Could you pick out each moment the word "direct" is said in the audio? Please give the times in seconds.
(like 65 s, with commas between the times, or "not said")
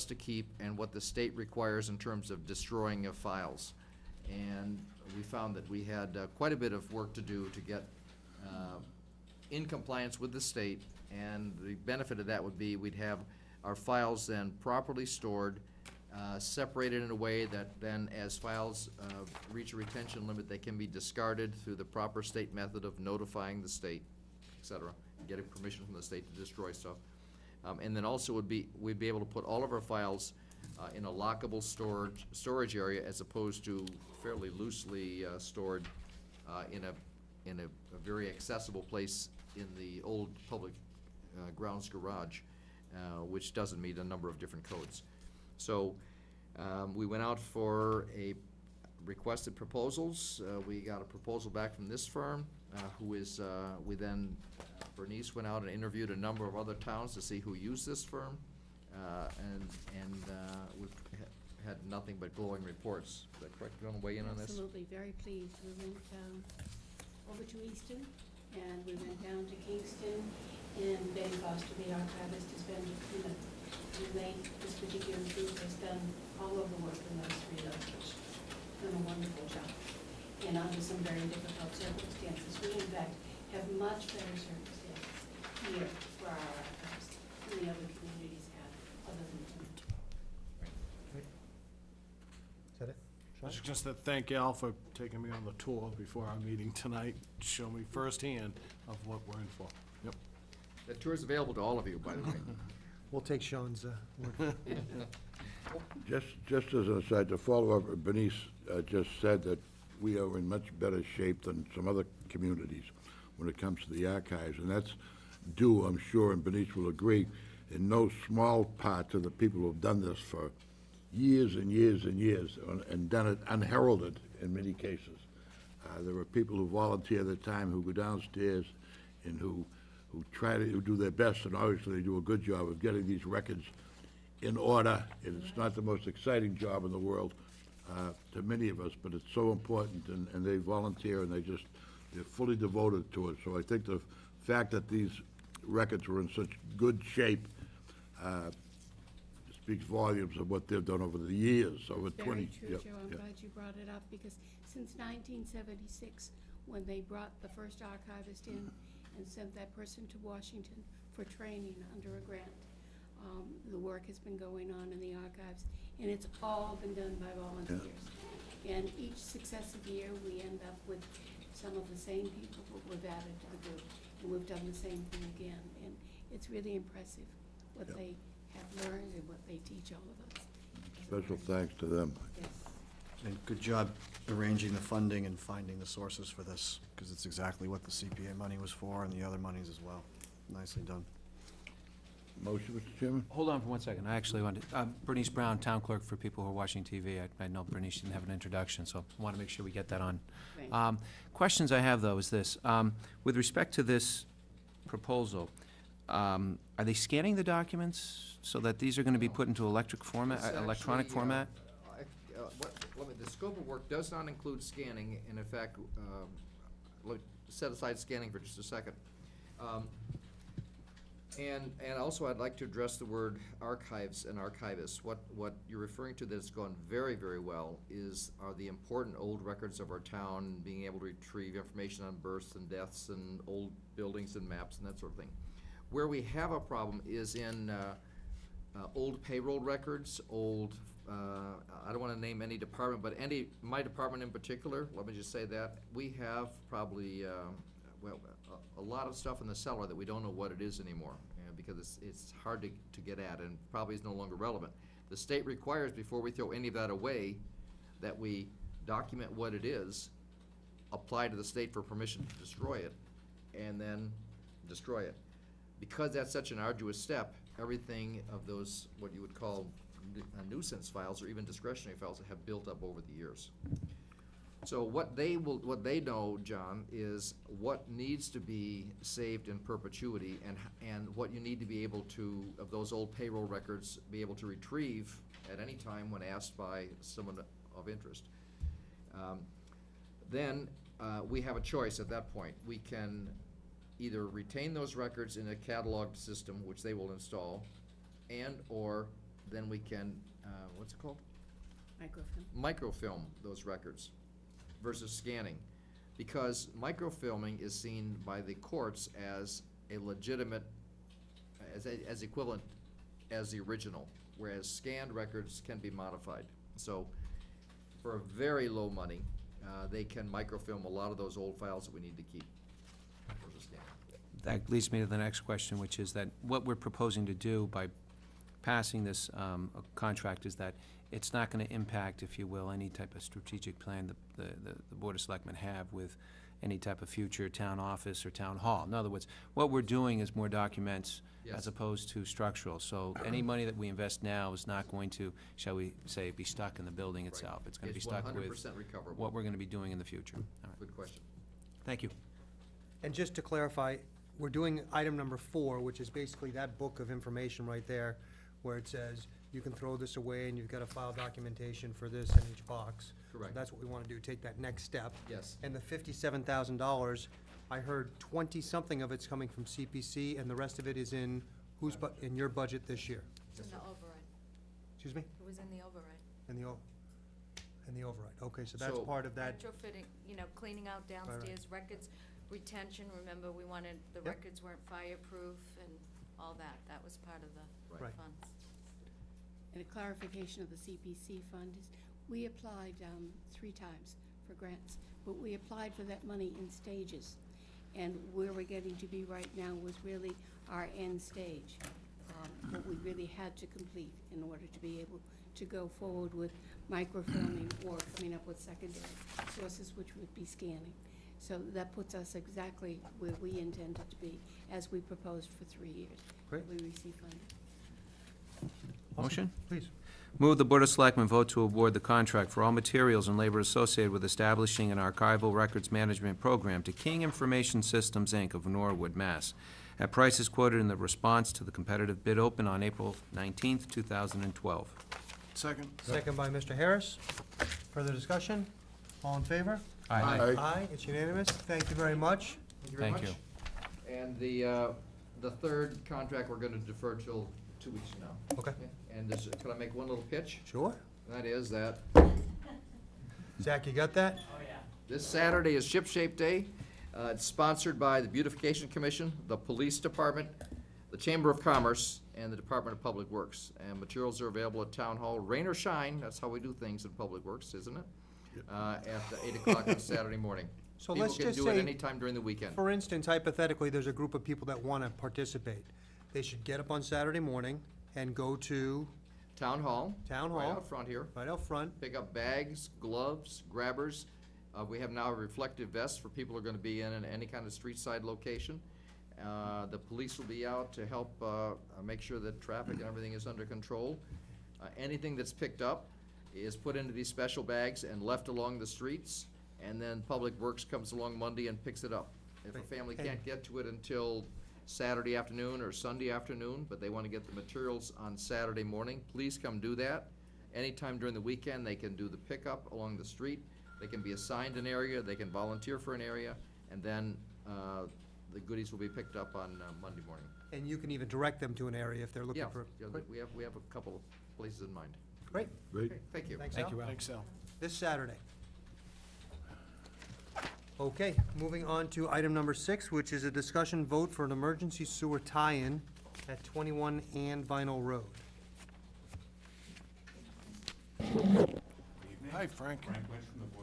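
521 s.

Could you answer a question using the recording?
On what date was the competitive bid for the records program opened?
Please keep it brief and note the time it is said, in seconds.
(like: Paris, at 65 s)
April 19th, 2012, at 432 s.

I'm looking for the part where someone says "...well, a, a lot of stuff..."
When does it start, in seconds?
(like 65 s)
248 s.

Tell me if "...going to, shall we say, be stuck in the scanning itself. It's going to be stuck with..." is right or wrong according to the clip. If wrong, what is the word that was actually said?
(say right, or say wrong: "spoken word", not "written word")
wrong: "building", not "scanning".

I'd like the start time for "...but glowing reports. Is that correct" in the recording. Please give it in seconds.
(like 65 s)
62 s.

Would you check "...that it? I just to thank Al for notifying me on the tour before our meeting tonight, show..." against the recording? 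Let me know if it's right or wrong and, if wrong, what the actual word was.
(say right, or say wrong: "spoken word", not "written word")
wrong: "taking", not "notifying".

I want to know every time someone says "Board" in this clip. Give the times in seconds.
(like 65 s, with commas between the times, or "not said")
334 s, 420 s.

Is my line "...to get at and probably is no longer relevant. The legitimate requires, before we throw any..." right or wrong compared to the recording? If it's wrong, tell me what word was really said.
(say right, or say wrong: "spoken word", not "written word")
wrong: "state", not "legitimate".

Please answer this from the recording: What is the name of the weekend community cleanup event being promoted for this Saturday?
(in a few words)
Ship Shape Day.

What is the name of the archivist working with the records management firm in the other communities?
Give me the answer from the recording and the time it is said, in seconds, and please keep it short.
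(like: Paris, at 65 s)
Ben Foster, at 71 s.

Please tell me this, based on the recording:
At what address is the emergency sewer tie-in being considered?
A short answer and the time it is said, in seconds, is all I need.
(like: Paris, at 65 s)
21 Ann Vinal Road, at 536 s.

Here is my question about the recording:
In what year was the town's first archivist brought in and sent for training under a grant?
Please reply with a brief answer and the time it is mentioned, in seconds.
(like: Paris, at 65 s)
1976, at 154 s.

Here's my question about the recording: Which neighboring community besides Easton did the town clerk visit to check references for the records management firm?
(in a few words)
Kingston.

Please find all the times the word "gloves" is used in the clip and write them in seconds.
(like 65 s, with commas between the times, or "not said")
482 s.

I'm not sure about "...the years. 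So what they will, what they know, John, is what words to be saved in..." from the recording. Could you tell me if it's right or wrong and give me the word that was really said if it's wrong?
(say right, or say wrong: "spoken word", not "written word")
wrong: "needs", not "words".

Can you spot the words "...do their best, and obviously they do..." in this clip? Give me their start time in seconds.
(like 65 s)
130 s.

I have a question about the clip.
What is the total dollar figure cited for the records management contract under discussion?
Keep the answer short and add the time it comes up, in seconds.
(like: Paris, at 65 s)
$57,000, at 365 s.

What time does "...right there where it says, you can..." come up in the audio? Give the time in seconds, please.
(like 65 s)
357 s.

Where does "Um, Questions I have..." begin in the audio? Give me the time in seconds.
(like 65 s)
200 s.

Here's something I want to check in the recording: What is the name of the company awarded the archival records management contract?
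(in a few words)
King Information Systems, Inc.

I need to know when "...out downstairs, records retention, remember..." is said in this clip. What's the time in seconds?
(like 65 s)
380 s.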